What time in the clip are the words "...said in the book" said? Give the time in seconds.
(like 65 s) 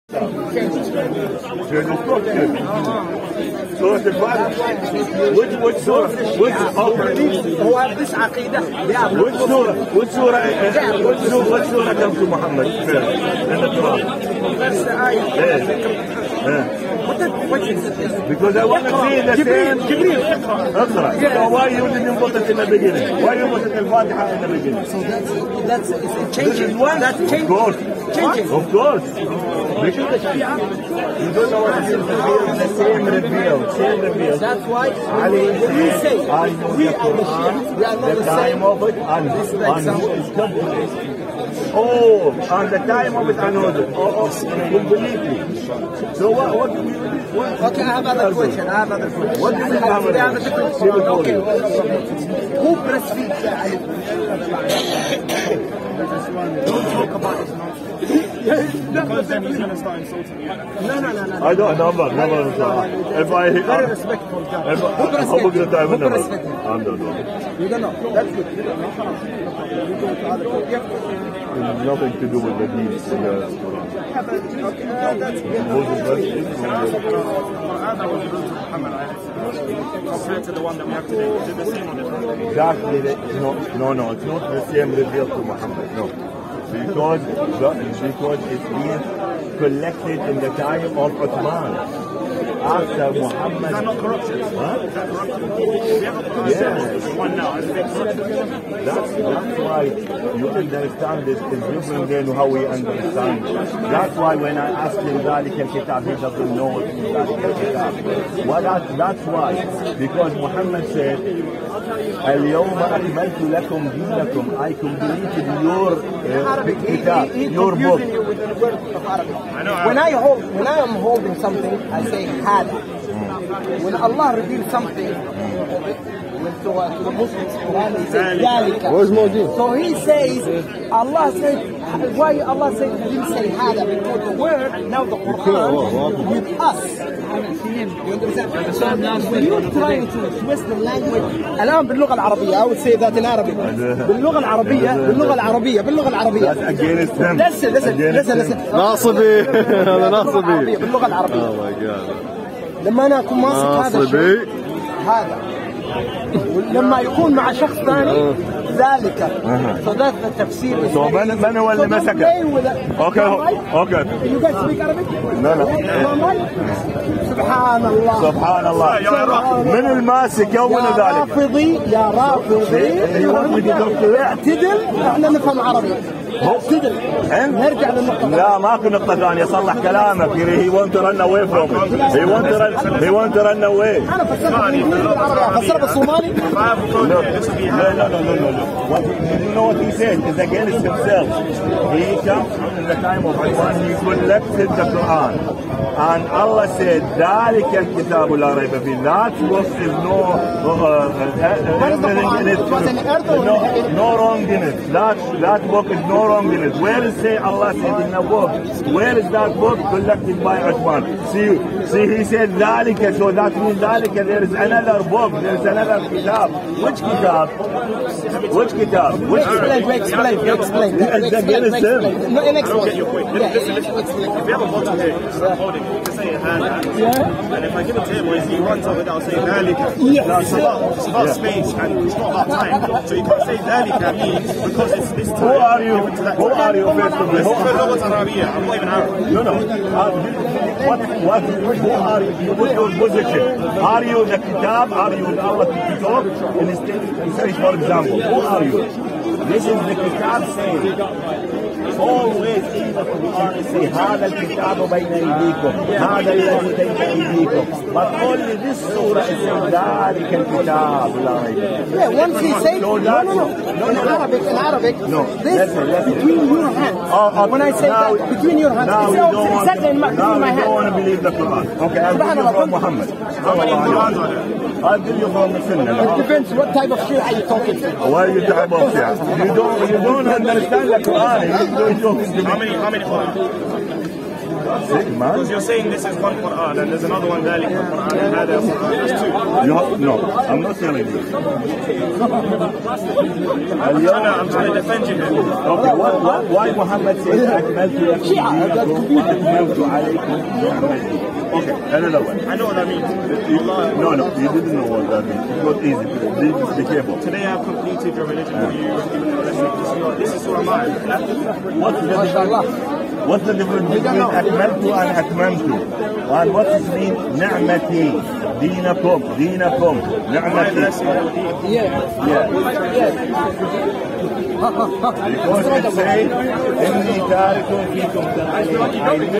207 s.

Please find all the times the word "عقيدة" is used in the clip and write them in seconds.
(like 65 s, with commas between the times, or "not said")
8 s.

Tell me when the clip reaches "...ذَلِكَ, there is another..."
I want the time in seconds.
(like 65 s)
213 s.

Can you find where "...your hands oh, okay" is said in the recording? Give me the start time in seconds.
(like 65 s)
266 s.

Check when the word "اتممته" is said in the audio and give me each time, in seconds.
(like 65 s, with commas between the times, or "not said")
315 s.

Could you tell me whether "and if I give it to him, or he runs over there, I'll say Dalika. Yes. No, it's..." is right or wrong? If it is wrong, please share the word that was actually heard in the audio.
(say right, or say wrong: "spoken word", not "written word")
right.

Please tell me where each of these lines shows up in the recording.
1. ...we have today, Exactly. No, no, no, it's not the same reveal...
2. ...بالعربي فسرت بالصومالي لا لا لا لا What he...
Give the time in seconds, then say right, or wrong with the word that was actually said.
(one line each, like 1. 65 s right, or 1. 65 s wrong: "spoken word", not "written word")
1. 80 s right
2. 184 s right.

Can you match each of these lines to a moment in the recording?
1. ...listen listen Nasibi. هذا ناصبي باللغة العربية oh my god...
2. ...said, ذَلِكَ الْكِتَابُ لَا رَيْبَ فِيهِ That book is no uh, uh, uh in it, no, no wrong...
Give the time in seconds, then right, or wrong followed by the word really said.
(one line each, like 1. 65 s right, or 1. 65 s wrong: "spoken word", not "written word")
1. 148 s right
2. 196 s right.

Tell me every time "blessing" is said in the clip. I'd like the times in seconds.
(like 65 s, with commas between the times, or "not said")
309 s.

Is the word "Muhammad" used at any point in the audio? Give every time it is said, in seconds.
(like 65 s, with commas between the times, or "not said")
85 s, 93 s, 110 s, 272 s, 296 s.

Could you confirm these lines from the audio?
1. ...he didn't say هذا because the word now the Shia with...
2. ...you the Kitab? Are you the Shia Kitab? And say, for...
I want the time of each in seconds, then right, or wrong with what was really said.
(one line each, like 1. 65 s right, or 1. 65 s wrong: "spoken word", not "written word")
1. 133 s wrong: "Quran", not "Shia"
2. 244 s wrong: "Allah", not "Shia".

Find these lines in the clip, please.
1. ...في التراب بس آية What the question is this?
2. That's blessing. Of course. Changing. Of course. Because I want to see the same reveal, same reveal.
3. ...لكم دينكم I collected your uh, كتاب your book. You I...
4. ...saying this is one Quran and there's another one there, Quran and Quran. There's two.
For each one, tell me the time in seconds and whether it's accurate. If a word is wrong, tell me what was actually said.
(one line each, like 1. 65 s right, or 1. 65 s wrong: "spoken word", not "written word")
1. 12 s right
2. 26 s wrong: "changing", not "blessing"
3. 113 s wrong: "completed", not "collected"
4. 285 s right.